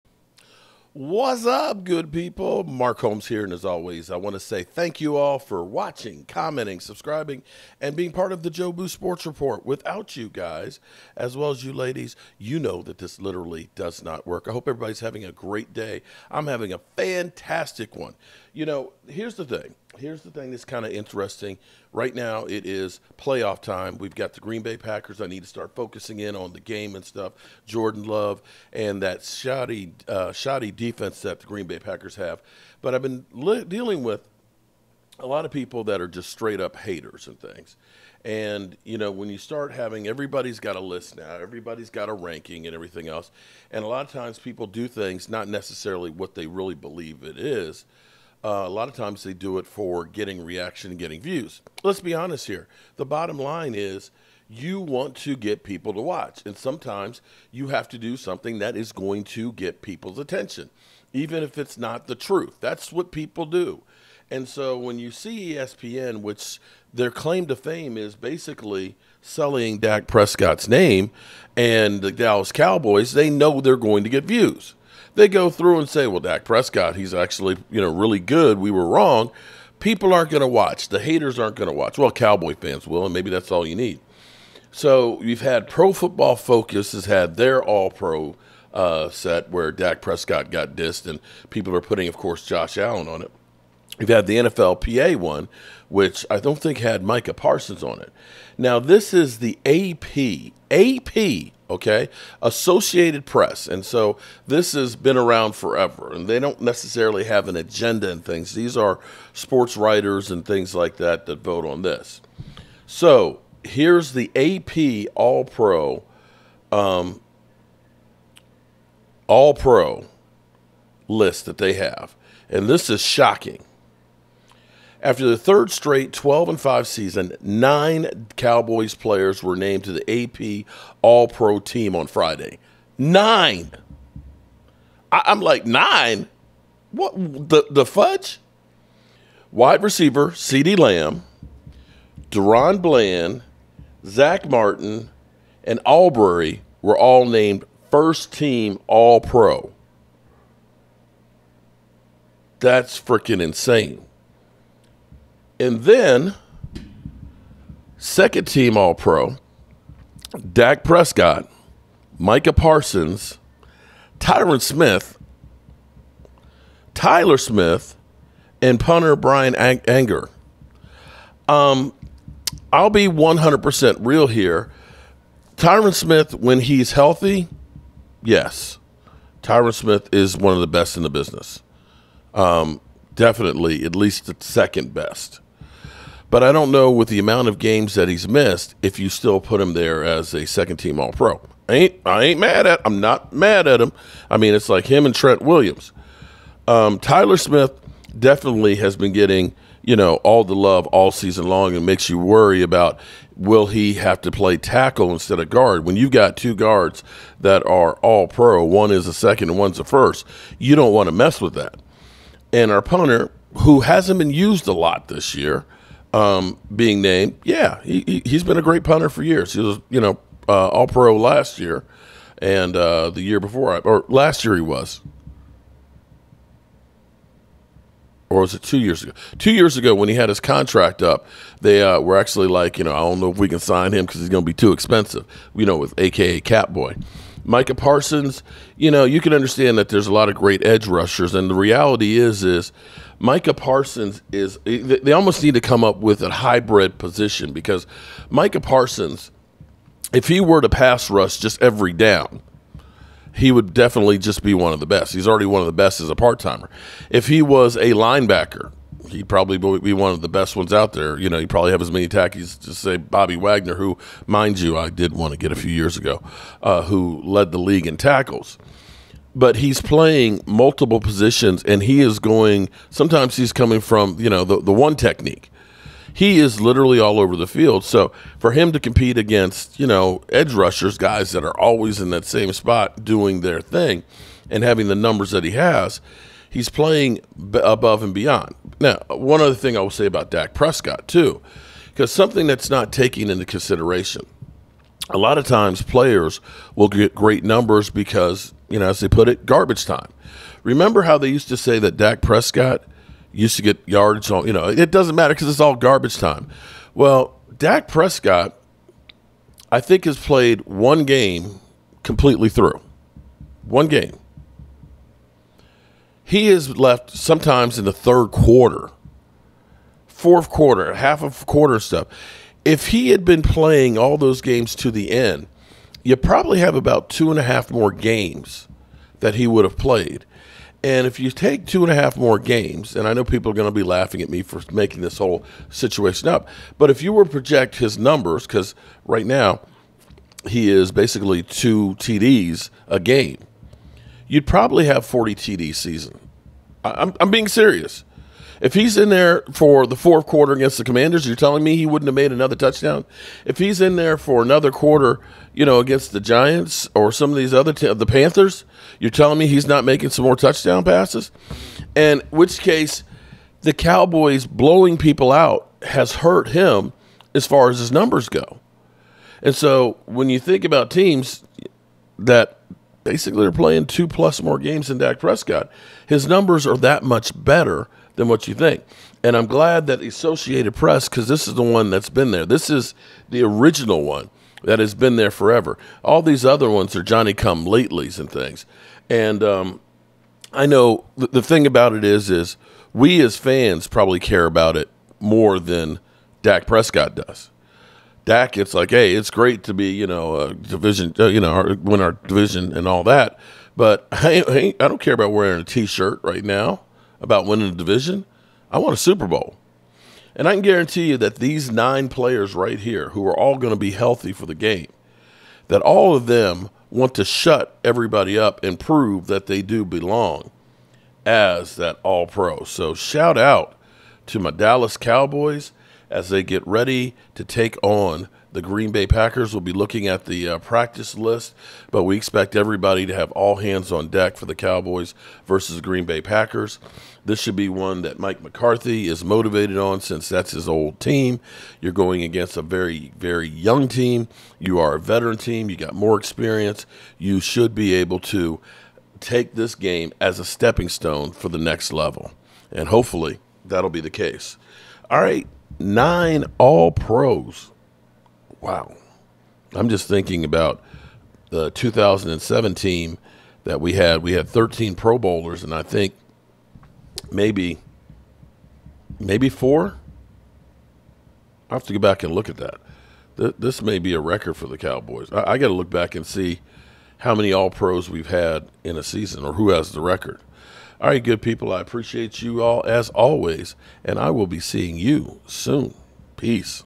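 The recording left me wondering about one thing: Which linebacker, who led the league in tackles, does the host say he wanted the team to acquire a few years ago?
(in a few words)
Bobby Wagner.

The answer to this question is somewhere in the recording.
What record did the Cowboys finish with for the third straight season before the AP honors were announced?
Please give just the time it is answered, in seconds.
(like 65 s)
126 s.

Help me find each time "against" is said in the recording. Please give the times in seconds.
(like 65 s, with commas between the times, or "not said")
279 s, 350 s, 355 s, 442 s.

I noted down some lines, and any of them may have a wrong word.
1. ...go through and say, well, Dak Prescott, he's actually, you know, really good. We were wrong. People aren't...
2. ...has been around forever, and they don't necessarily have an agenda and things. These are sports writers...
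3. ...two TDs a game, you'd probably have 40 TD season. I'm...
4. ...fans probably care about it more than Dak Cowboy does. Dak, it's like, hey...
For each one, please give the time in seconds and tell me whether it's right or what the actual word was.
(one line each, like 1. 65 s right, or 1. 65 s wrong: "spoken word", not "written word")
1. 75 s right
2. 104 s right
3. 341 s right
4. 393 s wrong: "Prescott", not "Cowboy".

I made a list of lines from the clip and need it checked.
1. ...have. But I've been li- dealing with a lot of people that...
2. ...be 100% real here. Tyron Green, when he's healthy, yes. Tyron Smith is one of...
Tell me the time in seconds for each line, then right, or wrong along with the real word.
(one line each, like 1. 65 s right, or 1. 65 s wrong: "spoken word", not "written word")
1. 32 s right
2. 172 s wrong: "Smith", not "Green".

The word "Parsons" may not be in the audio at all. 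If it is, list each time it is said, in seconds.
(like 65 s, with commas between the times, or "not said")
97 s, 162 s, 237 s, 243 s, 248 s.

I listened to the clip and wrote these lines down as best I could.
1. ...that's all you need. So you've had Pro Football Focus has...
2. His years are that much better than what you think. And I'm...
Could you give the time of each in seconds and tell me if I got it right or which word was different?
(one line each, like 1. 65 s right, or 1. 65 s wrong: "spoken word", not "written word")
1. 83 s right
2. 376 s wrong: "numbers", not "years".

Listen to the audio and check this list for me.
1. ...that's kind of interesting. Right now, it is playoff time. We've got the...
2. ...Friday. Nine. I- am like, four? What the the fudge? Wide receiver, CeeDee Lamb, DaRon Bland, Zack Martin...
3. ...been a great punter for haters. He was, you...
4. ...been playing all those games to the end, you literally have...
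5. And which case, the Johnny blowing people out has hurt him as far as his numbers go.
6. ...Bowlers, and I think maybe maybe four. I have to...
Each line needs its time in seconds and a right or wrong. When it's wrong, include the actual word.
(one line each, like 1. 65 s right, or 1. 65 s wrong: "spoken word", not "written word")
1. 20 s right
2. 132 s wrong: "nine", not "four"
3. 218 s wrong: "years", not "haters"
4. 323 s wrong: "probably", not "literally"
5. 361 s wrong: "Cowboys", not "Johnny"
6. 465 s right.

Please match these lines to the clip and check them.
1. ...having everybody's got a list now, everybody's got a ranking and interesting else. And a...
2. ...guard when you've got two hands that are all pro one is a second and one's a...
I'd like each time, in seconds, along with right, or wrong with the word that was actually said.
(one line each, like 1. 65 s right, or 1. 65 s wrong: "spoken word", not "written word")
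1. 39 s wrong: "everything", not "interesting"
2. 205 s wrong: "guards", not "hands".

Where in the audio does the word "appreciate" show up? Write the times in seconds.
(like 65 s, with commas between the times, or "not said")
481 s.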